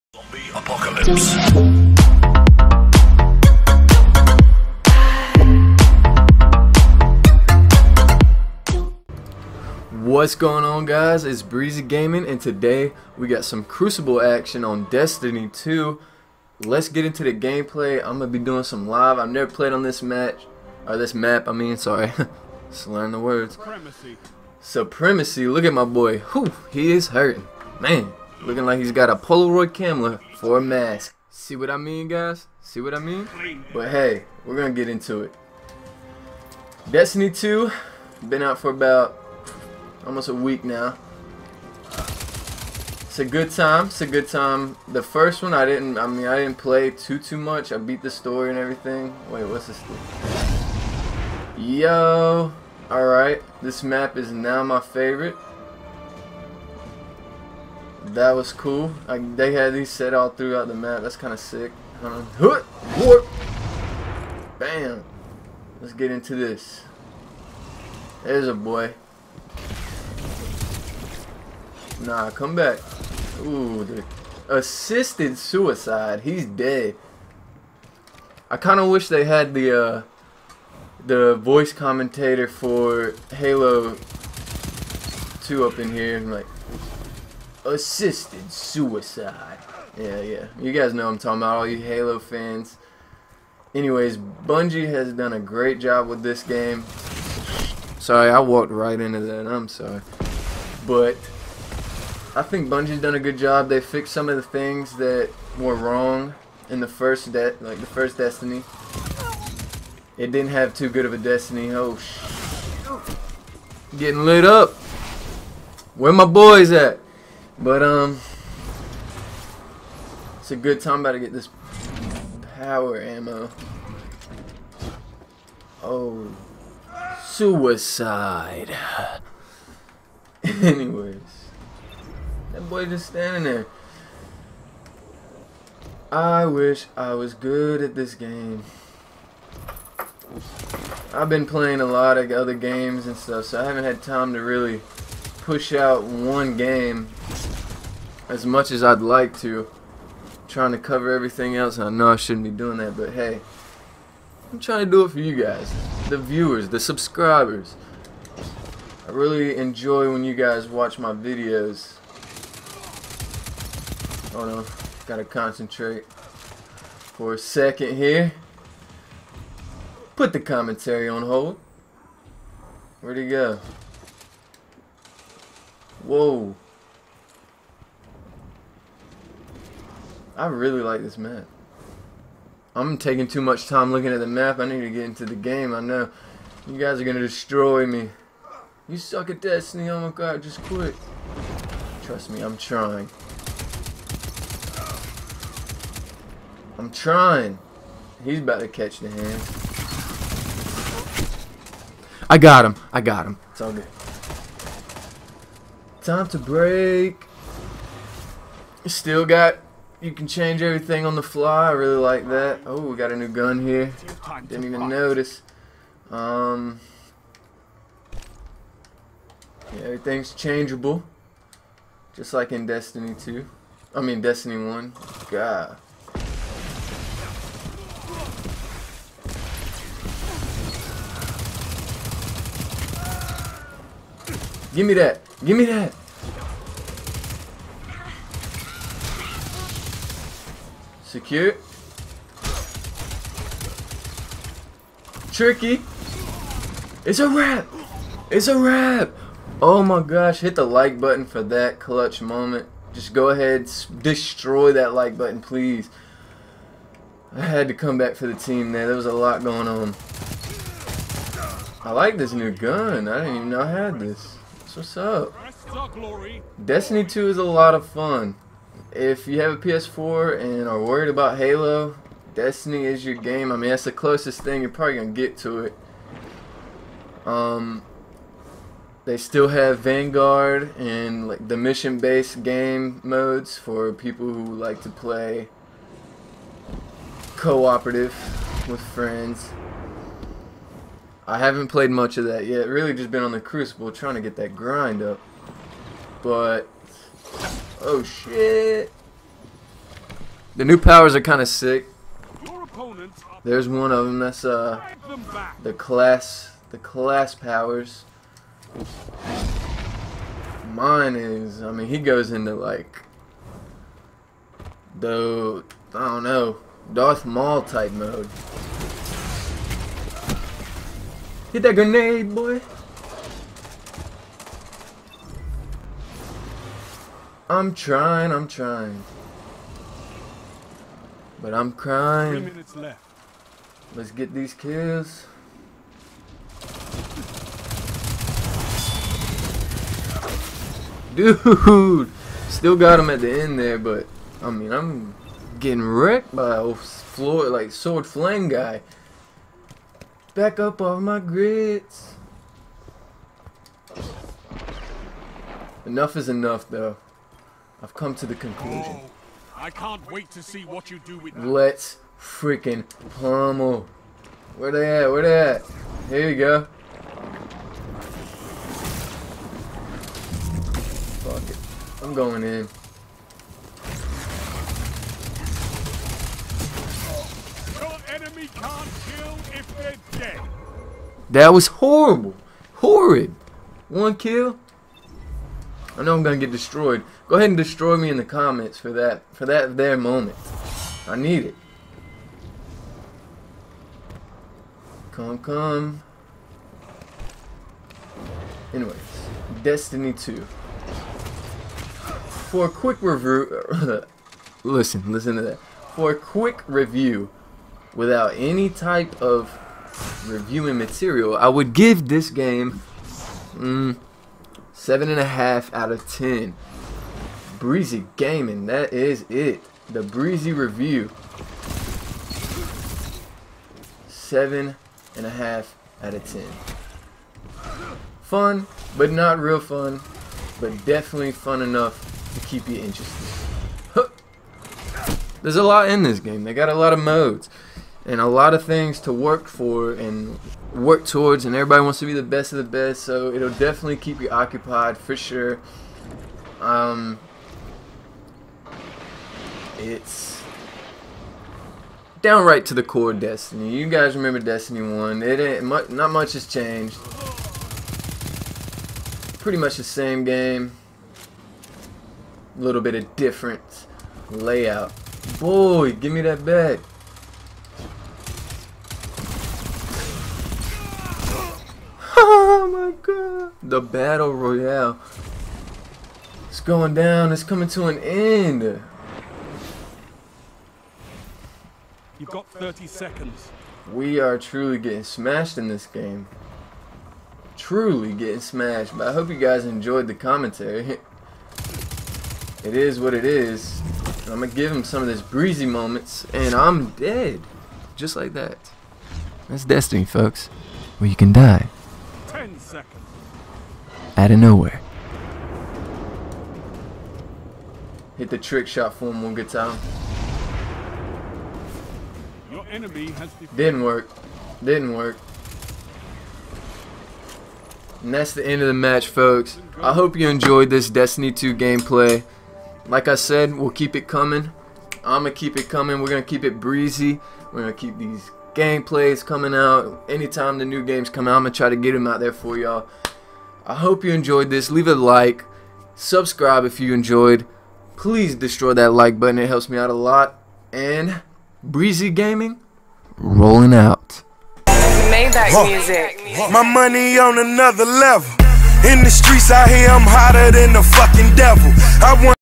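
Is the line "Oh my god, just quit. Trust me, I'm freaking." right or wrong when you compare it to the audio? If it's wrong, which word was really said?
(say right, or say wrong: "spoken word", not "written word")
wrong: "trying", not "freaking".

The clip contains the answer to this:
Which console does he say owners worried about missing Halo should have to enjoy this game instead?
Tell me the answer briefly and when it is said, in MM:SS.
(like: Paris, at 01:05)
PS4, at 04:29.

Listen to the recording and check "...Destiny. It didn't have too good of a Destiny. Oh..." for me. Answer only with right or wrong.
right.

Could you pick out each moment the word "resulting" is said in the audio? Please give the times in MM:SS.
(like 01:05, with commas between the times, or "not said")
not said.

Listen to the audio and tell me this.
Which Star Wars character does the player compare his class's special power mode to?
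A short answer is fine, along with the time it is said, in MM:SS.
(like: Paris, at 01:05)
Darth Maul, at 05:16.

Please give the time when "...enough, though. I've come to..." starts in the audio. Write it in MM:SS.
05:56.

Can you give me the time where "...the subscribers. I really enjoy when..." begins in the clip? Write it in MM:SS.
02:36.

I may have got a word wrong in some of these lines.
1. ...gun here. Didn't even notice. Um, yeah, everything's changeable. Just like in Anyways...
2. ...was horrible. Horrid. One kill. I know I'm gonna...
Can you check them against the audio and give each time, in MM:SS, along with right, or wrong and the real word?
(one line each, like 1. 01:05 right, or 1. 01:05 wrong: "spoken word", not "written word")
1. 03:33 wrong: "Destiny", not "Anyways"
2. 06:21 right.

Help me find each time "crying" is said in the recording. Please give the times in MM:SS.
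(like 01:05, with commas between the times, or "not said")
05:31.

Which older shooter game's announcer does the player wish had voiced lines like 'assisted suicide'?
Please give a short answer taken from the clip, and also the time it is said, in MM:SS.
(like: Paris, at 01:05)
Halo 2, at 01:23.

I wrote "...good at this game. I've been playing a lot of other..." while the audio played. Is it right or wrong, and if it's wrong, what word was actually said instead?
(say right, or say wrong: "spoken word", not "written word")
right.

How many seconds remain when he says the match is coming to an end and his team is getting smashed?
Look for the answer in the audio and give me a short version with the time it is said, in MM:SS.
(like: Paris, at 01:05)
30, at 08:02.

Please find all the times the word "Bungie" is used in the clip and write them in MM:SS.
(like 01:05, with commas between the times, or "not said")
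01:34, 01:42.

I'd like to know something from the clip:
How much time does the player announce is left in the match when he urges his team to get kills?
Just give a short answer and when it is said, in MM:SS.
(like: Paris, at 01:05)
3 minutes, at 05:32.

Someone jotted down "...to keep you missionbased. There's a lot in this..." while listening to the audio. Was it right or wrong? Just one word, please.
wrong.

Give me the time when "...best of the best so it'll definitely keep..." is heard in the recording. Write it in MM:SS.
07:22.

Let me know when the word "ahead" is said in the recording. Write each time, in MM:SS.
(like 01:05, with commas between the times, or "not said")
04:13, 06:27.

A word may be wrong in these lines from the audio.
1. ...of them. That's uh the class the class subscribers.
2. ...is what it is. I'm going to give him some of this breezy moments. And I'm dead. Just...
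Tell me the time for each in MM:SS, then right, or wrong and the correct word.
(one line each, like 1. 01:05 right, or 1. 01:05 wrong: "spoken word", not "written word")
1. 05:03 wrong: "powers", not "subscribers"
2. 08:12 right.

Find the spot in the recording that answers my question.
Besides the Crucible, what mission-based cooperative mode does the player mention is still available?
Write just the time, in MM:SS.
04:39.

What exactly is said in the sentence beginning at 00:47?
I beat the story and everything.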